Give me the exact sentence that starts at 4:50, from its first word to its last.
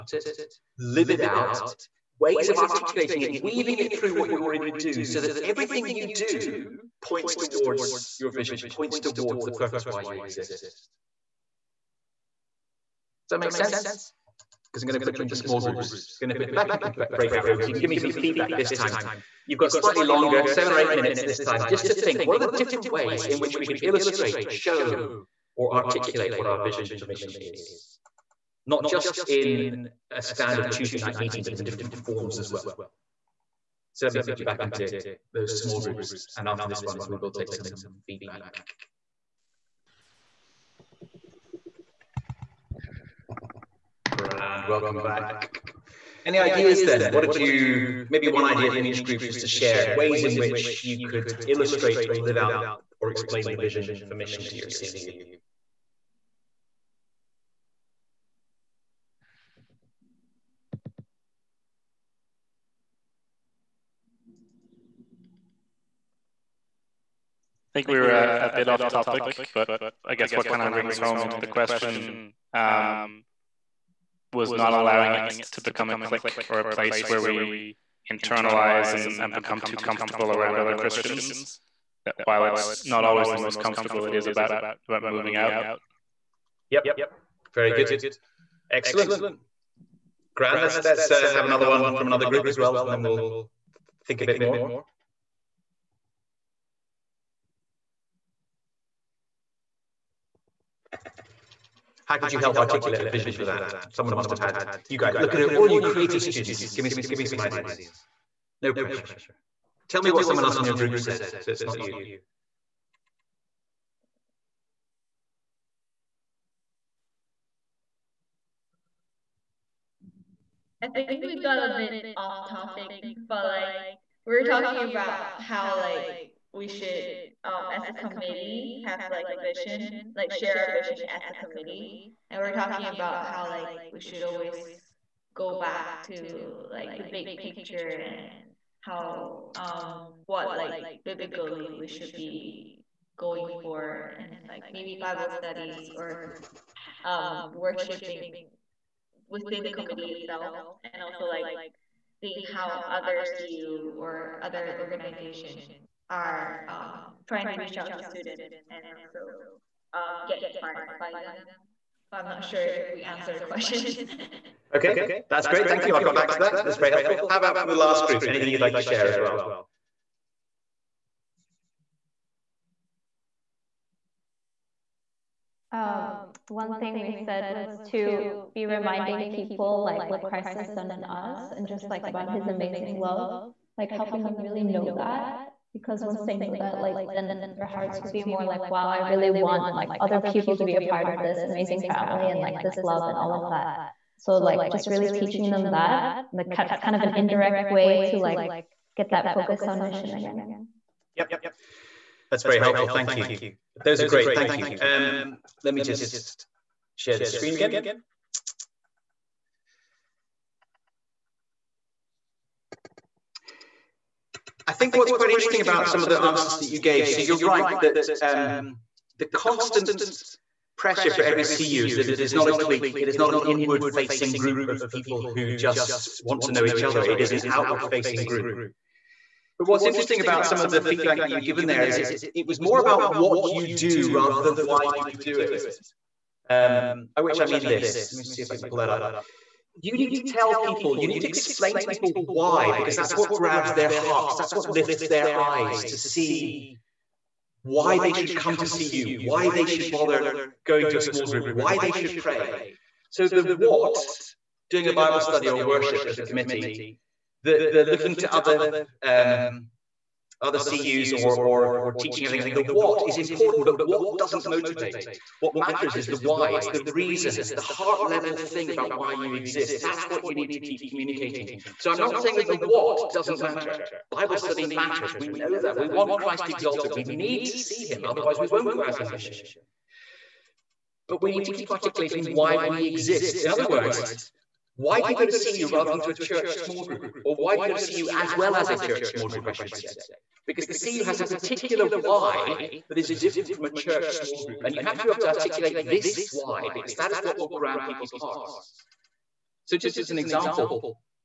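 because the CU has a particular why that is different from a church small group.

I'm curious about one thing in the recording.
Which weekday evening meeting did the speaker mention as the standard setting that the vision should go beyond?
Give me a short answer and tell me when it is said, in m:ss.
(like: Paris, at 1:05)
Tuesday, at 0:30.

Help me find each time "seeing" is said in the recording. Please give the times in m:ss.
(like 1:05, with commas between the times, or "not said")
2:32.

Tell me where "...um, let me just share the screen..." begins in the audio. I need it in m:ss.
3:24.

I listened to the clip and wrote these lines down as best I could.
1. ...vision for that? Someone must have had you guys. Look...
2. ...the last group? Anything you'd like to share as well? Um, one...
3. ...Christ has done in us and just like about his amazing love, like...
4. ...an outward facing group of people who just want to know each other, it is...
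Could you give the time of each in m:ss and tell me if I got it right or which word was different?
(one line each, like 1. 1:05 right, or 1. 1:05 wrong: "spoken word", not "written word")
1. 1:43 right
2. 2:47 right
3. 3:00 right
4. 3:43 wrong: "inward", not "outward".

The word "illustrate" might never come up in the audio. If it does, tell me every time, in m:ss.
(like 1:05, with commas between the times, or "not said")
0:23, 0:51.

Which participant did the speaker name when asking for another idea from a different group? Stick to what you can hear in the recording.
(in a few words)
Grant.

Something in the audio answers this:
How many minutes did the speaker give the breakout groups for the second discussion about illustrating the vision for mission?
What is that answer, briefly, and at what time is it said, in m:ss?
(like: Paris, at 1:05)
7 or 8 minutes, at 0:20.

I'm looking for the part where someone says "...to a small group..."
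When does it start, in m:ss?
4:10.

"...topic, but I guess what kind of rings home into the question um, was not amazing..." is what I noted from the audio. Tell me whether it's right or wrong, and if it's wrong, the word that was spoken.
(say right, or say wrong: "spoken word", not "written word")
wrong: "allowing", not "amazing".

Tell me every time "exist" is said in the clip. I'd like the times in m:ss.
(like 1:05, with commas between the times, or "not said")
0:10, 4:29, 4:42.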